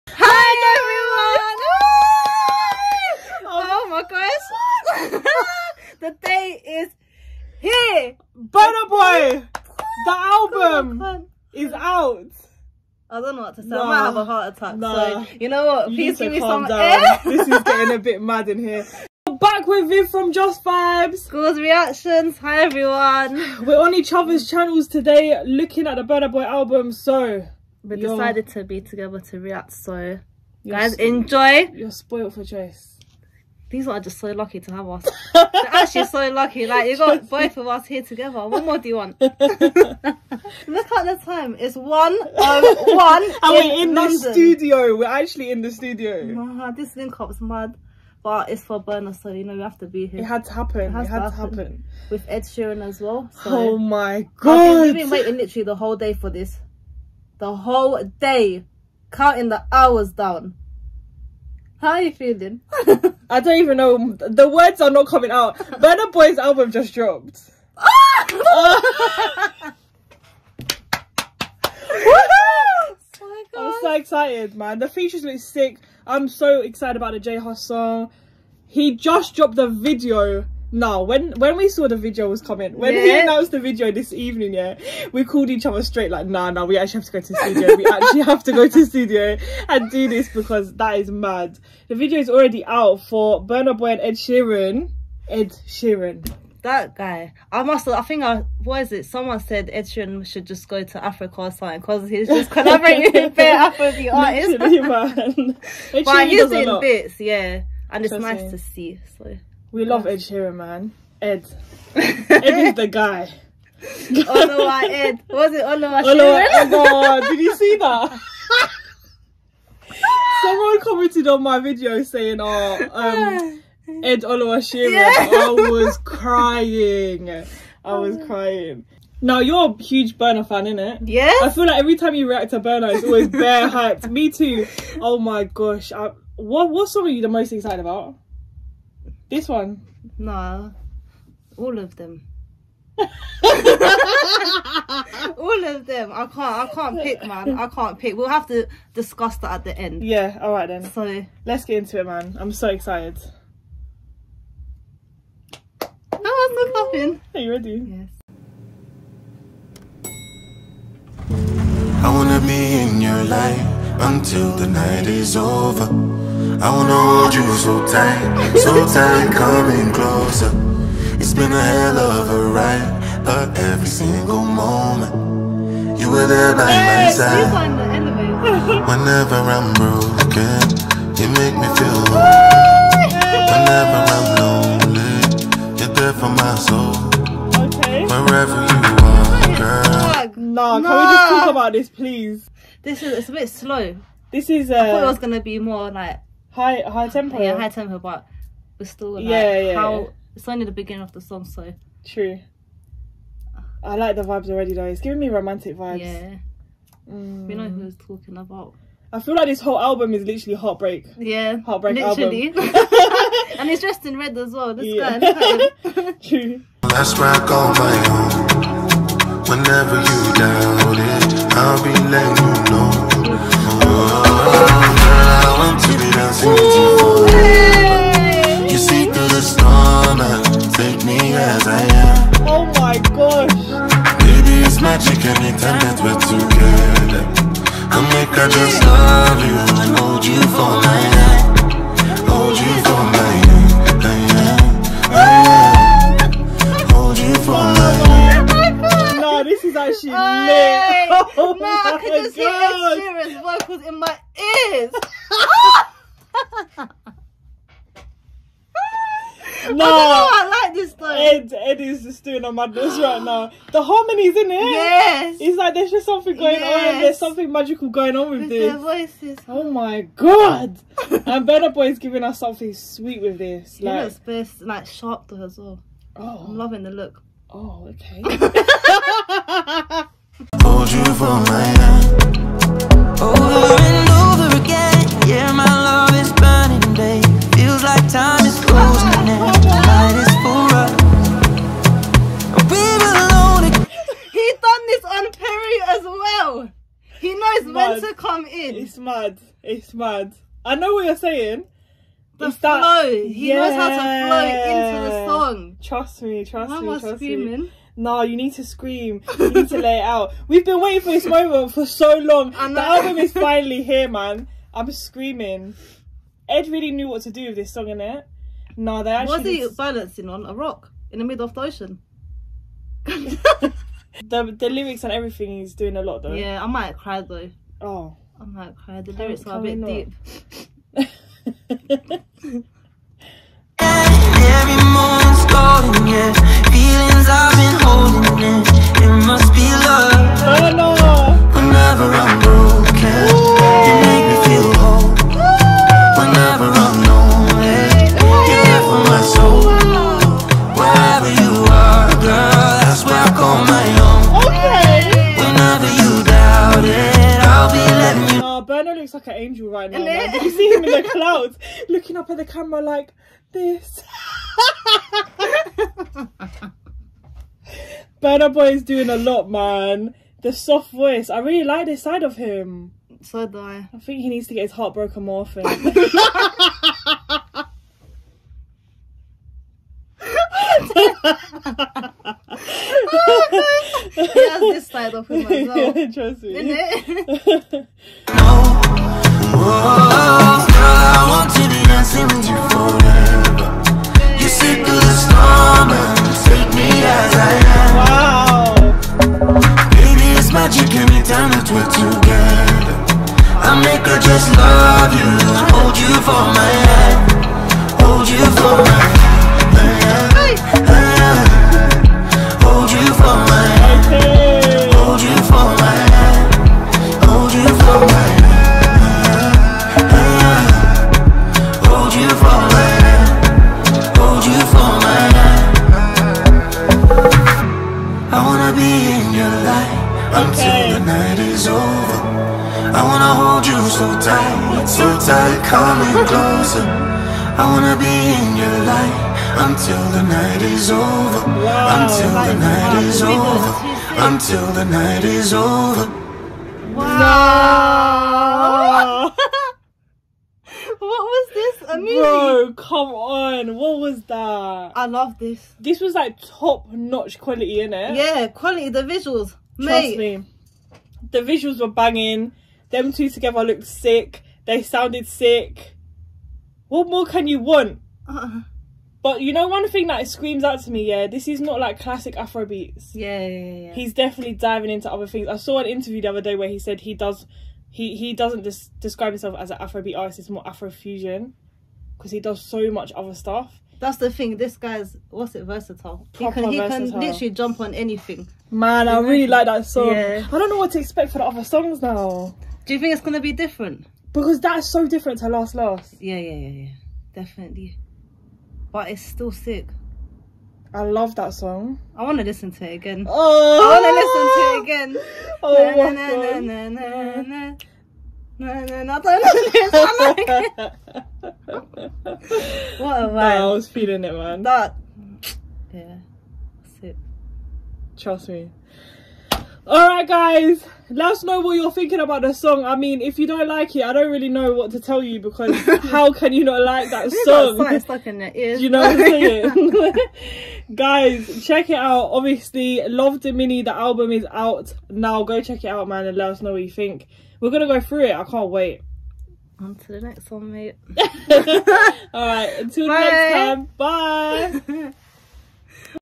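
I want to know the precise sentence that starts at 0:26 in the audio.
So we decided to be together to react.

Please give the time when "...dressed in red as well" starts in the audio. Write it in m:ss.
3:33.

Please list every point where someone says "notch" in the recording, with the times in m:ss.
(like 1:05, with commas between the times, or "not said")
7:36.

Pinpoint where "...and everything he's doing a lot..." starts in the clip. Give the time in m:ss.
5:25.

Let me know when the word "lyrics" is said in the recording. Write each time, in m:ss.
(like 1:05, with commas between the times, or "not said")
5:24, 5:29.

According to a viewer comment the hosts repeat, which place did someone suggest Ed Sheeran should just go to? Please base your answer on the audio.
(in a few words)
Africa.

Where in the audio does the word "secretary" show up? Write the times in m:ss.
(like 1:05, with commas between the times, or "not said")
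not said.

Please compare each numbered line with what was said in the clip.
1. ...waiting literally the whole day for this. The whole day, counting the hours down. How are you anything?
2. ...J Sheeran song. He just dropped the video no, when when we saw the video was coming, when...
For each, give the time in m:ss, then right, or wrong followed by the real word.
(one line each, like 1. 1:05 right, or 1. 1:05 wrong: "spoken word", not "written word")
1. 0:55 wrong: "feeling", not "anything"
2. 1:17 wrong: "Hus", not "Sheeran".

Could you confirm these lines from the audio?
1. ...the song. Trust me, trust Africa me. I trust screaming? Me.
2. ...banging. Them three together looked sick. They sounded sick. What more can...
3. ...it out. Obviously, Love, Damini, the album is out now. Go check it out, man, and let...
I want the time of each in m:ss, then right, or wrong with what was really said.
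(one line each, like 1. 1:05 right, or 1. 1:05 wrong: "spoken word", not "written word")
1. 5:05 wrong: "Why", not "Africa"
2. 7:41 wrong: "two", not "three"
3. 8:51 right.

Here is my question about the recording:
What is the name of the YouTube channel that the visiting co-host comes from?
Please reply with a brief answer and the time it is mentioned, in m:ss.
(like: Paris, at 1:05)
Just Vibes, at 0:20.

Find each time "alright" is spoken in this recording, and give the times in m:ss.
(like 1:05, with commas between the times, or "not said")
2:30, 8:39.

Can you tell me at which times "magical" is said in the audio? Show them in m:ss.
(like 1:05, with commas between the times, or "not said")
4:27.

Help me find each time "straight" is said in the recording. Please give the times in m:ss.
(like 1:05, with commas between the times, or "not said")
1:25.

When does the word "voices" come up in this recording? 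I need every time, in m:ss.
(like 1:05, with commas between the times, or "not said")
4:28, 6:10.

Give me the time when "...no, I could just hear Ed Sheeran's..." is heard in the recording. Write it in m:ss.
4:11.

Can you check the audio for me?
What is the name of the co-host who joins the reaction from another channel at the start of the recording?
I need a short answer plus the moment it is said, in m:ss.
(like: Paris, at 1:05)
Viv, at 0:19.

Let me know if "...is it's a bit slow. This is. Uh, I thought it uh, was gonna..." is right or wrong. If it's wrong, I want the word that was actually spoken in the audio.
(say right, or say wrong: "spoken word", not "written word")
right.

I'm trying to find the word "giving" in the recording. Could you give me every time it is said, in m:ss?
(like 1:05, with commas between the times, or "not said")
3:25, 4:31.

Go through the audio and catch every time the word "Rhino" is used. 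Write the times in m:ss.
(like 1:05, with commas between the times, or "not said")
5:58.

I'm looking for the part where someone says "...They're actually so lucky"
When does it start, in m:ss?
0:35.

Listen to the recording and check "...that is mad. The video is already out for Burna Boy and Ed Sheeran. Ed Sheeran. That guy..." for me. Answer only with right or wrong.
right.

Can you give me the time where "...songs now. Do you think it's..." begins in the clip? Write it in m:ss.
8:11.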